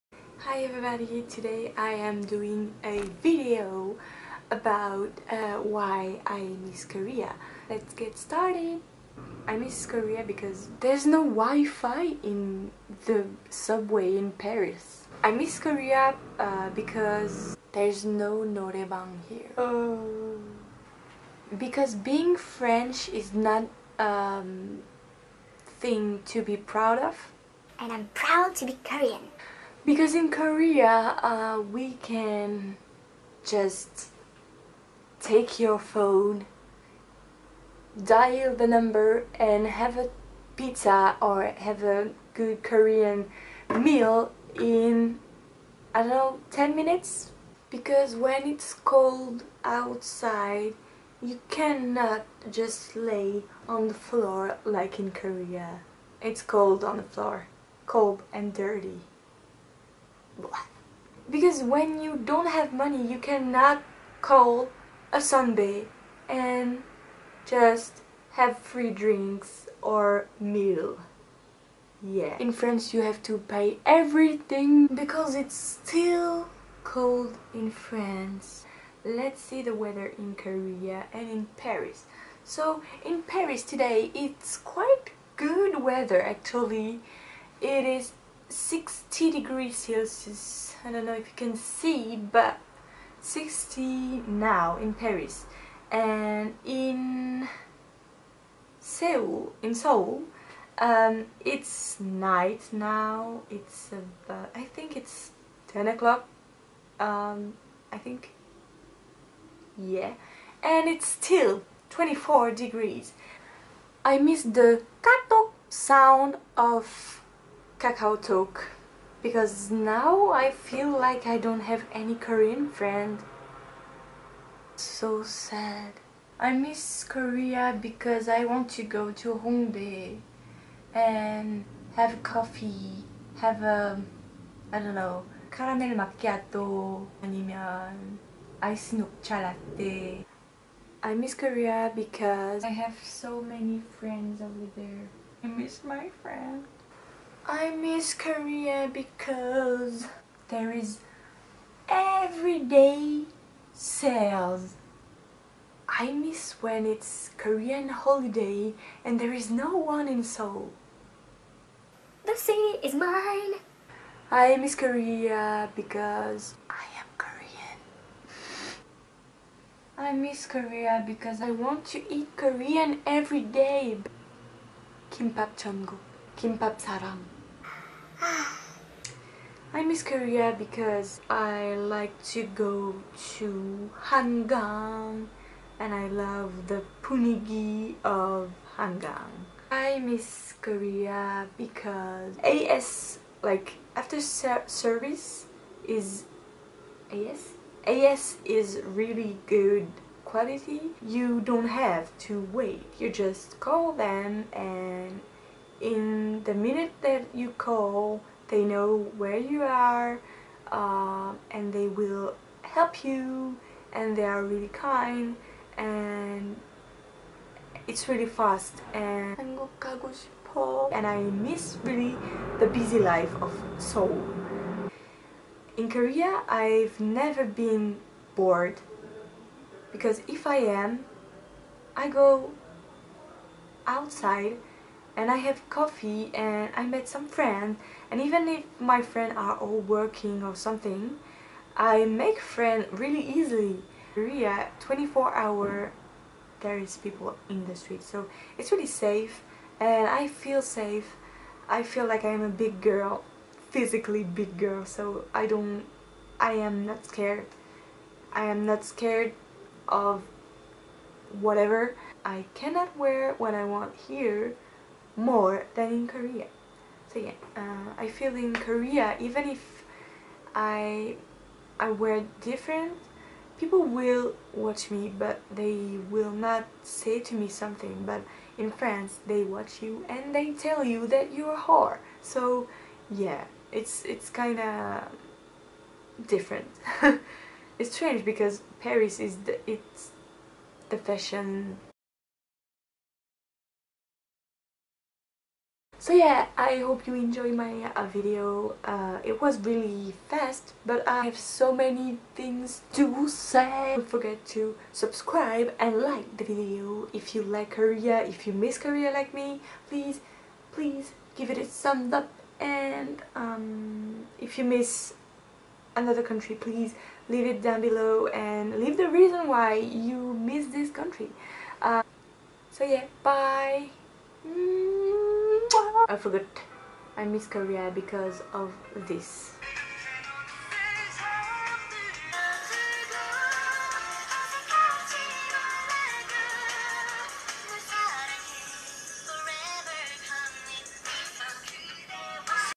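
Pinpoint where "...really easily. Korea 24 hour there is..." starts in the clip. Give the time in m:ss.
4:02.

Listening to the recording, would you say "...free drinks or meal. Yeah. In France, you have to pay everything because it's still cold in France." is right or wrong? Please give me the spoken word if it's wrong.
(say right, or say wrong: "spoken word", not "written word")
right.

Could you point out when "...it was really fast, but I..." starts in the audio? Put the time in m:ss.
4:59.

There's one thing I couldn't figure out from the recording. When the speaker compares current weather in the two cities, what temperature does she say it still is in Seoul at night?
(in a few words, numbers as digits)
24 degrees.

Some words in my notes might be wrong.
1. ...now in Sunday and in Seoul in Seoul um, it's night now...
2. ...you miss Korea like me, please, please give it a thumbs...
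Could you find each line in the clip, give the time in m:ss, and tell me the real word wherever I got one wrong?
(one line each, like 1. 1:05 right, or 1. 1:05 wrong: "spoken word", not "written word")
1. 1:34 wrong: "Paris", not "Sunday"
2. 5:08 right.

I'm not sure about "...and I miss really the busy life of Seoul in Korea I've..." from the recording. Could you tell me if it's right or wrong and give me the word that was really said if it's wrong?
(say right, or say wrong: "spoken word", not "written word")
right.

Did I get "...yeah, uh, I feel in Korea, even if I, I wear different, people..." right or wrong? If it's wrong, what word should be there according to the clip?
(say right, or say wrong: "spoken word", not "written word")
right.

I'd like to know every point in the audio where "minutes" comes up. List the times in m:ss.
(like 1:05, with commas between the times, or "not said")
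0:46, 3:26.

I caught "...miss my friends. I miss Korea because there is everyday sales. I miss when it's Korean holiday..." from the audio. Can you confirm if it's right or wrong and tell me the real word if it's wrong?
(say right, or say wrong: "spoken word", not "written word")
right.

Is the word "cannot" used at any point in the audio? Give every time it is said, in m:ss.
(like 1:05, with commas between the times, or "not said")
0:51, 1:03, 4:22.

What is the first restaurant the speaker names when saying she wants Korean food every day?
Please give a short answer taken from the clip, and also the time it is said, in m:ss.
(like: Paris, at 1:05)
Kimbap Cheonguk, at 2:55.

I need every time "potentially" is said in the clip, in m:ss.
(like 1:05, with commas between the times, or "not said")
not said.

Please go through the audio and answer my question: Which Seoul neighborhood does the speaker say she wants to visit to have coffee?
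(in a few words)
Hongdae.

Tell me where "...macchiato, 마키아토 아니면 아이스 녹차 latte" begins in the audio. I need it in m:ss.
2:15.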